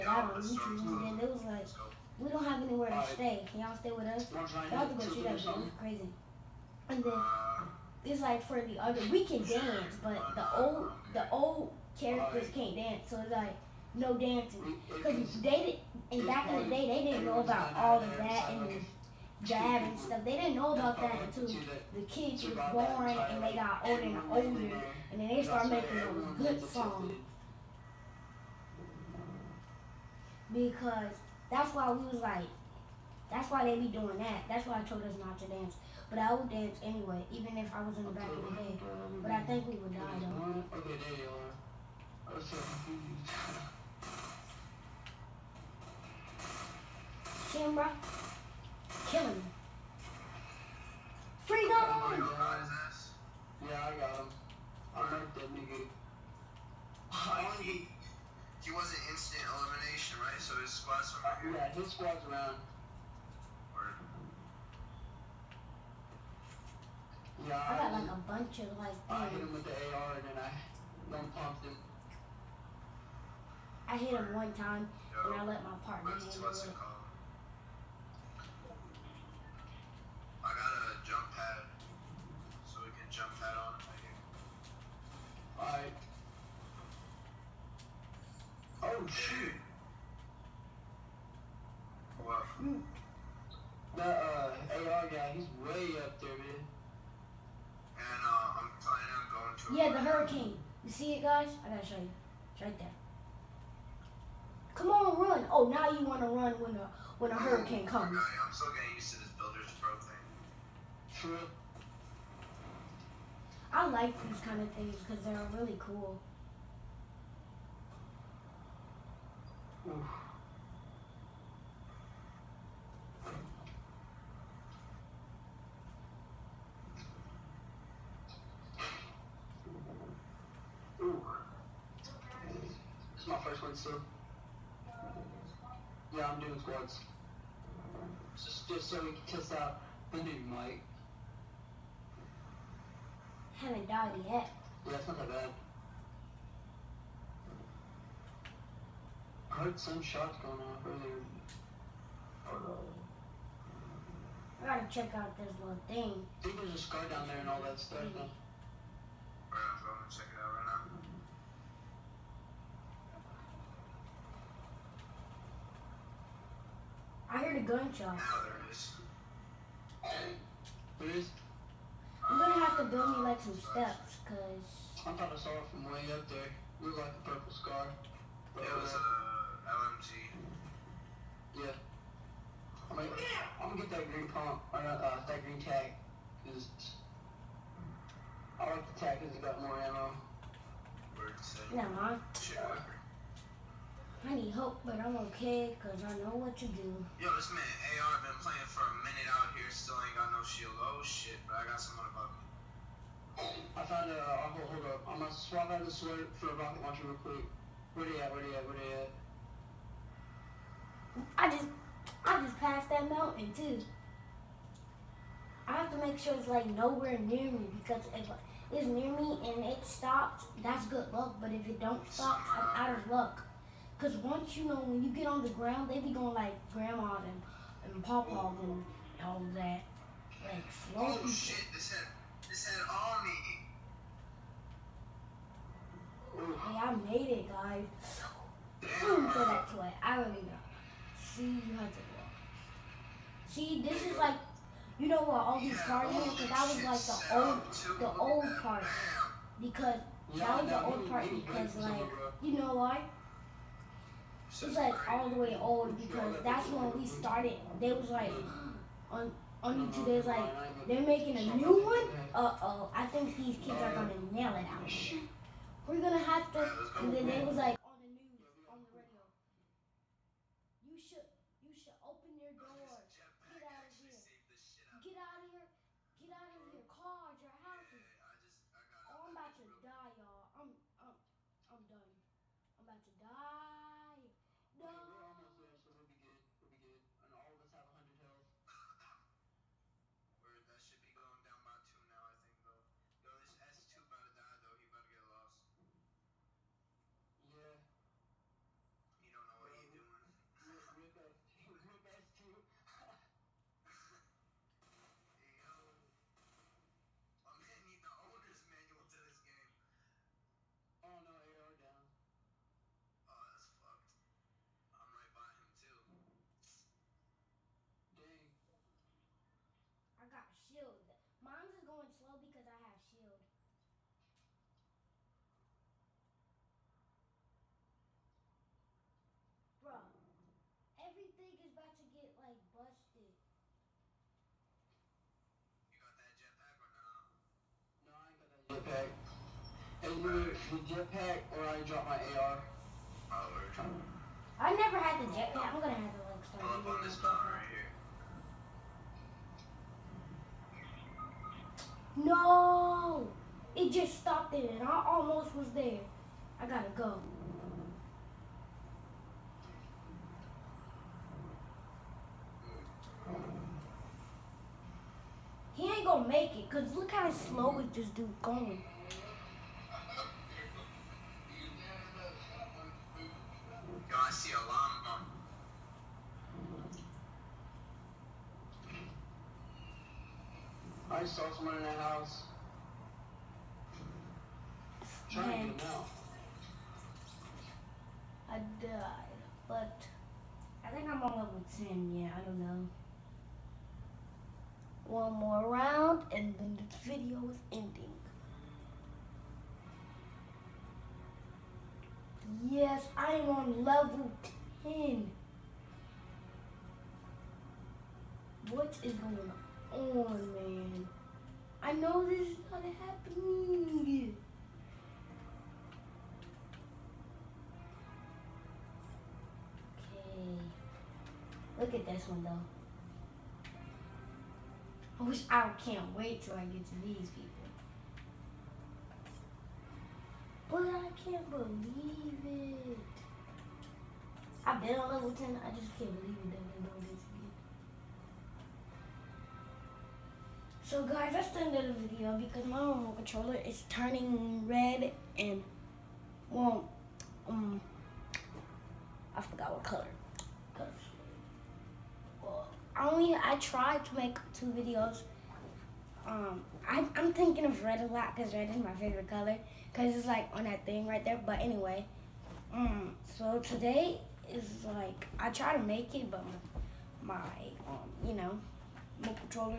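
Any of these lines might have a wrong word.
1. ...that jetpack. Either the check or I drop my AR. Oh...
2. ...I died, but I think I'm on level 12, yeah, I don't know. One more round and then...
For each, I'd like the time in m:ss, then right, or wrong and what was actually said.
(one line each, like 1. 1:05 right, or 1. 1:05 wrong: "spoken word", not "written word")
1. 5:38 wrong: "jetpack", not "check"
2. 6:28 wrong: "10", not "12".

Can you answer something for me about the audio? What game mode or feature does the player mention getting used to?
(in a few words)
builder's pro.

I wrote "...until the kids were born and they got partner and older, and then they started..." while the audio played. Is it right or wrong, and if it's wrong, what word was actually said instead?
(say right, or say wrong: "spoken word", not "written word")
wrong: "older", not "partner".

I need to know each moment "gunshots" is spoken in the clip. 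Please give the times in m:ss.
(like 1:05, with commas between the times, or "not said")
2:47.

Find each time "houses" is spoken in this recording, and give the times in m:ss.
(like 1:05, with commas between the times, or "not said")
4:37, 6:21.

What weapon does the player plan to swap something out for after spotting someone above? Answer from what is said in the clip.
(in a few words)
rocket launcher.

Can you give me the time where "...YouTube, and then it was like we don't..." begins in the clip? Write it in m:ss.
0:00.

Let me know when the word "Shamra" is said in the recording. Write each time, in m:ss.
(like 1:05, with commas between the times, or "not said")
0:47.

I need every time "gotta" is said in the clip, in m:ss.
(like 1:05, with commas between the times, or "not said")
1:41, 2:34, 5:56.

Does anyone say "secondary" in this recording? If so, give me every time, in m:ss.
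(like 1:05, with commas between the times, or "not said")
not said.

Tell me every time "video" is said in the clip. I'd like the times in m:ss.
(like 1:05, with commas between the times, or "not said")
6:37, 7:22, 7:34.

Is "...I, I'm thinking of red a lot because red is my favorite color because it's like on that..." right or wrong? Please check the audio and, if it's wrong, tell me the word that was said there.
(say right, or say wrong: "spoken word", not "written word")
right.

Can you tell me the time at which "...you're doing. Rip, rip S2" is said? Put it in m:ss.
4:59.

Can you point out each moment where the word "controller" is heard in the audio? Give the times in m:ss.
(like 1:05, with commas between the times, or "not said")
7:23.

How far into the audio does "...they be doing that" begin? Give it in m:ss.
0:33.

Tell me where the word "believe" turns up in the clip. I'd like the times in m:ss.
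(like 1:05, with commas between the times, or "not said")
7:11, 7:16.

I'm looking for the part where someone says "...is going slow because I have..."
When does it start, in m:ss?
5:21.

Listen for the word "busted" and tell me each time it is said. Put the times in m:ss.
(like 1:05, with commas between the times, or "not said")
5:32.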